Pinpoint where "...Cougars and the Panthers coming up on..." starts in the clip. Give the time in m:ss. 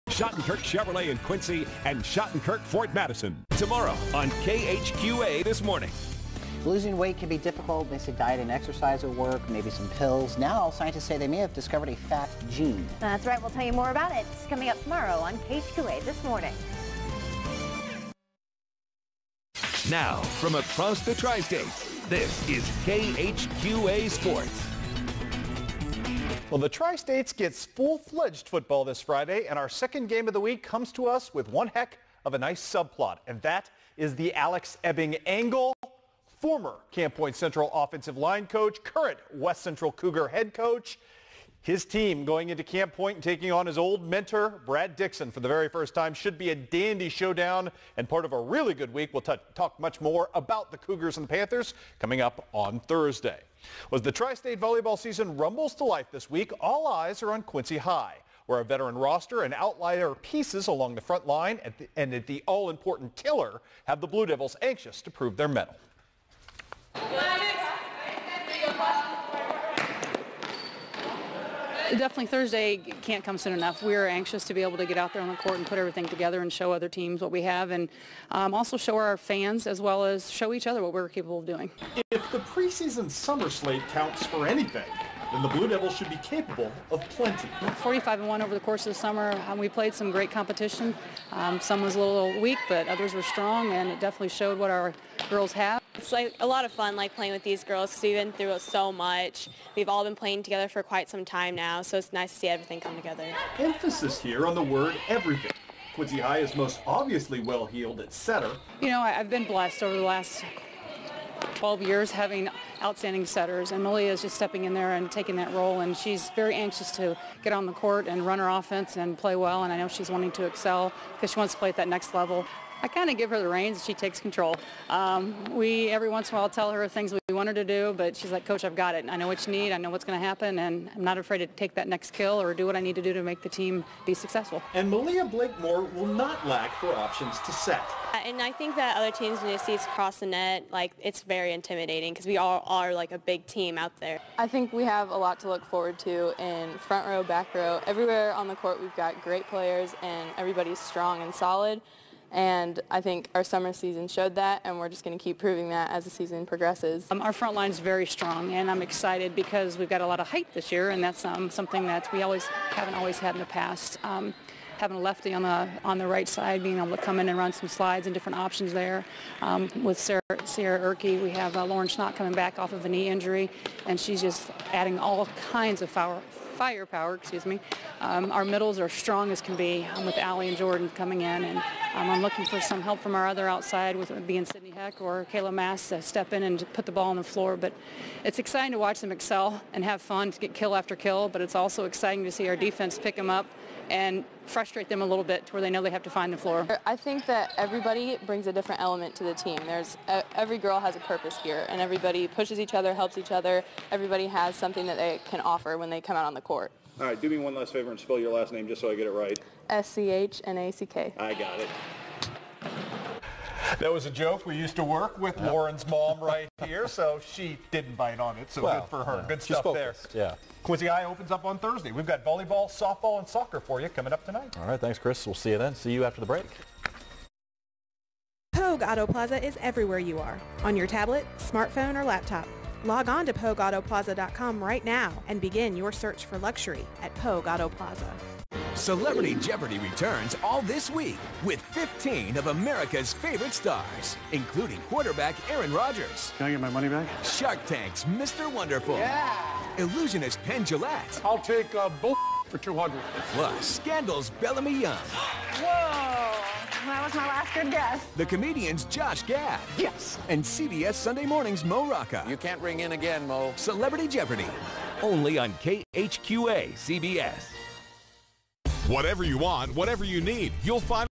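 0:50.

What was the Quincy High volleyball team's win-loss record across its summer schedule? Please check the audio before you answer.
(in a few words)
45 and 1.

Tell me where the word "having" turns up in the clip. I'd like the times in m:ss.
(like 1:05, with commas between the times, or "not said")
1:52, 2:44.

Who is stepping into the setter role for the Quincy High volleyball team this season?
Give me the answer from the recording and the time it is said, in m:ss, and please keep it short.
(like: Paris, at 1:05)
Malia Blakemore, at 2:14.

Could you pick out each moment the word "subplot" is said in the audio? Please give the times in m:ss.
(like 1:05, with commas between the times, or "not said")
0:32.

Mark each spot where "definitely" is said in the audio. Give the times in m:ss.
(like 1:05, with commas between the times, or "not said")
1:11, 1:33.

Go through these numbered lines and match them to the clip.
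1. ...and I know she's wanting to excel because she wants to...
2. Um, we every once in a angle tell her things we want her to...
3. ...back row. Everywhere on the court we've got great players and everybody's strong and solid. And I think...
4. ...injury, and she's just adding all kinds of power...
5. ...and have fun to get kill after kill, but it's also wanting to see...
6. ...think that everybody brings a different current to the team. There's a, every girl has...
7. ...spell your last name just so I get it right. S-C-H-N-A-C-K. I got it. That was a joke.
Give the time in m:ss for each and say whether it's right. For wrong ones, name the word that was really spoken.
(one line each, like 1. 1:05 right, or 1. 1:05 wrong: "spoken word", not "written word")
1. 1:59 right
2. 2:04 wrong: "while", not "angle"
3. 2:27 right
4. 2:53 right
5. 3:09 wrong: "exciting", not "wanting"
6. 3:16 wrong: "element", not "current"
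7. 3:27 right.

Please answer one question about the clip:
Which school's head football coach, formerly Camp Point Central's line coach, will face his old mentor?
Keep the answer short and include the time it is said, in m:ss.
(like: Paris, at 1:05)
West Central, at 0:39.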